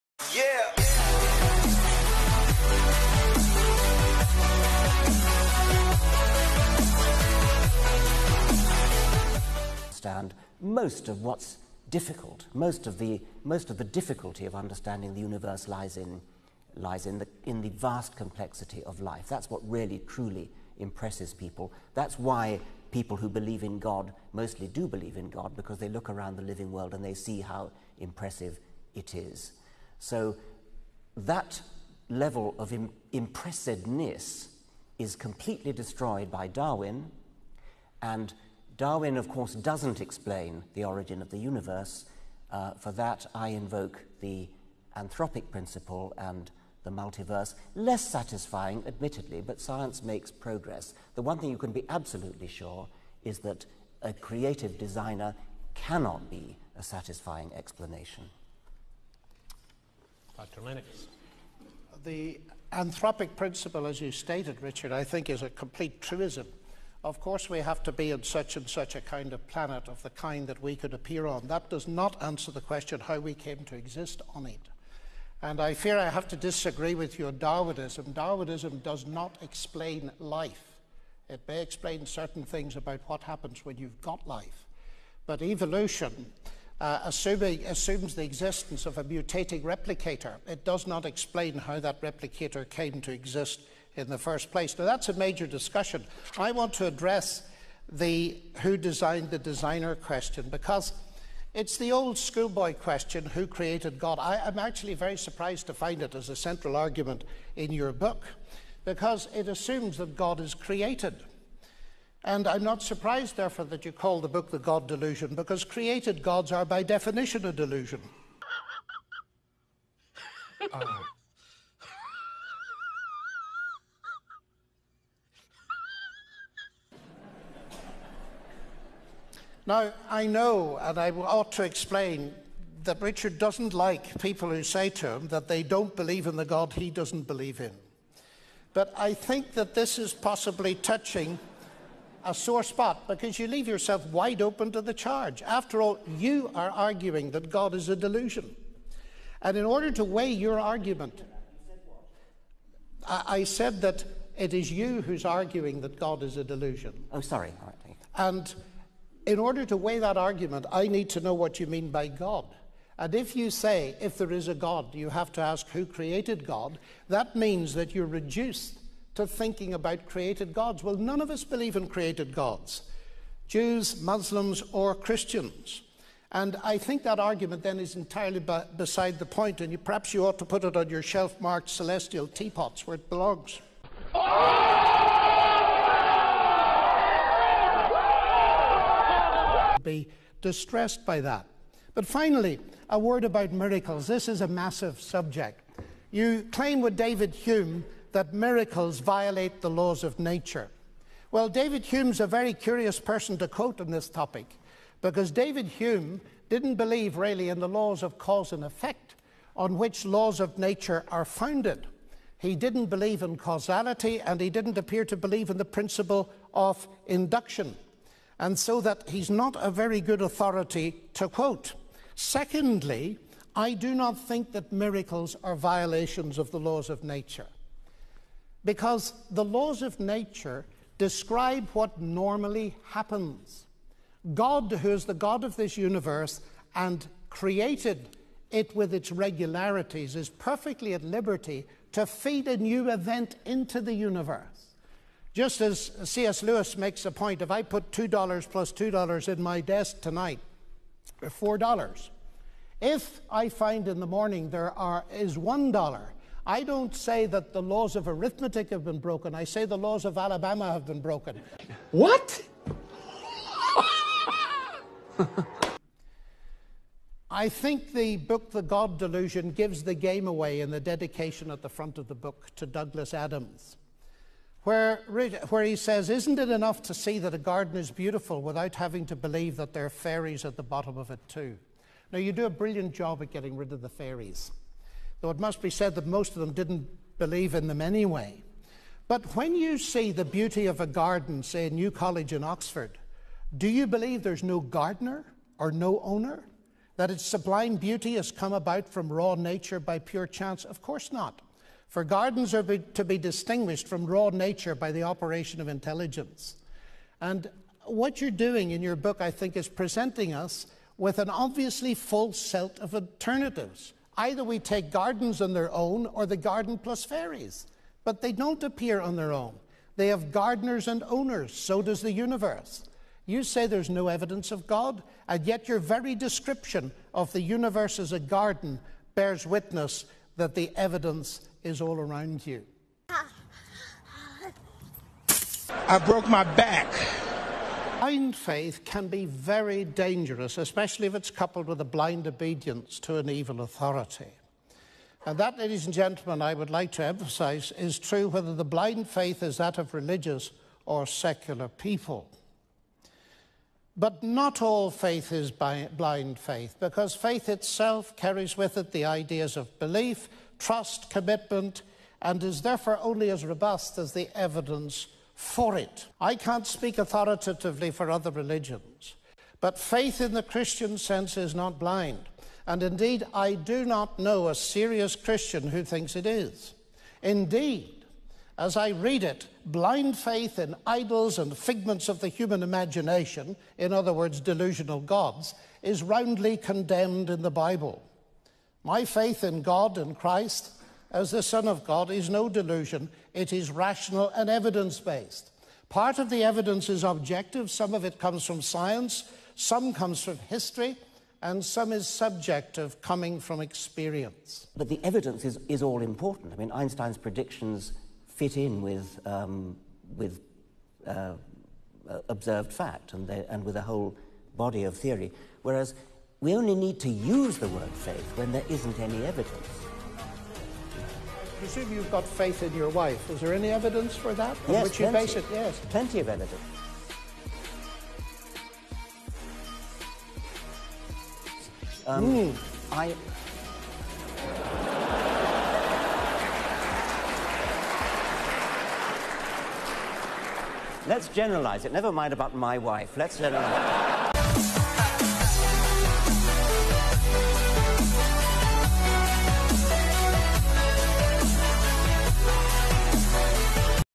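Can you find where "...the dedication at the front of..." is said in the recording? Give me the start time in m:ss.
4:30.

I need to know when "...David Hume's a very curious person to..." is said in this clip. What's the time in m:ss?
3:21.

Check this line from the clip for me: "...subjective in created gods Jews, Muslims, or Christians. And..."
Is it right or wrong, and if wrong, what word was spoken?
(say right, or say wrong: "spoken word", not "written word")
wrong: "believe", not "subjective".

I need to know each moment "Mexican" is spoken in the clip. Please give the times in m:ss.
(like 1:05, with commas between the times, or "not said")
not said.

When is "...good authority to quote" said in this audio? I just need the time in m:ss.
3:40.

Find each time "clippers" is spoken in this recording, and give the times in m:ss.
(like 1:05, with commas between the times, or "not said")
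not said.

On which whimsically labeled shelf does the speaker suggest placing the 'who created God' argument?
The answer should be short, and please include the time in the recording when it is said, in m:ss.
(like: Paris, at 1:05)
celestial teapots, at 3:01.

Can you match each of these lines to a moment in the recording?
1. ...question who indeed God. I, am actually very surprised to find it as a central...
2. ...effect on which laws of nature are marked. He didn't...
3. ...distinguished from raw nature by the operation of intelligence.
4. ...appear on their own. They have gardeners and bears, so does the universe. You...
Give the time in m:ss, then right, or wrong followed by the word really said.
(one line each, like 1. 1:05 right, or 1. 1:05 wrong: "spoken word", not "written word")
1. 1:42 wrong: "created", not "indeed"
2. 3:28 wrong: "founded", not "marked"
3. 5:03 right
4. 5:18 wrong: "owners", not "bears".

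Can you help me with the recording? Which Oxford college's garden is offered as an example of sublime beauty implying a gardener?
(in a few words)
New College.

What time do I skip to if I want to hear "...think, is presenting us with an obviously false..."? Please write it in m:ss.
5:09.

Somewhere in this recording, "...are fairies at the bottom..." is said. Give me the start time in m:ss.
4:39.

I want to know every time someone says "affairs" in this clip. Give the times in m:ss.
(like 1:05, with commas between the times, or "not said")
not said.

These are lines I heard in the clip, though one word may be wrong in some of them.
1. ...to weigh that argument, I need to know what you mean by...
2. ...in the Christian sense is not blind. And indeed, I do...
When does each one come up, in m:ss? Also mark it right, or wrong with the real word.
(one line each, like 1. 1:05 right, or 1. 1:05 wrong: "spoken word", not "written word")
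1. 2:39 right
2. 6:10 right.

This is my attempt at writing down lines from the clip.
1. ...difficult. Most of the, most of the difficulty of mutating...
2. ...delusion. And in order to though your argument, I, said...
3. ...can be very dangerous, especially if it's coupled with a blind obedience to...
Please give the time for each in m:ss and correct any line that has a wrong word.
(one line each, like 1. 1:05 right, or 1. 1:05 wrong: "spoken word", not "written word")
1. 0:11 wrong: "understanding", not "mutating"
2. 2:27 wrong: "weigh", not "though"
3. 5:38 right.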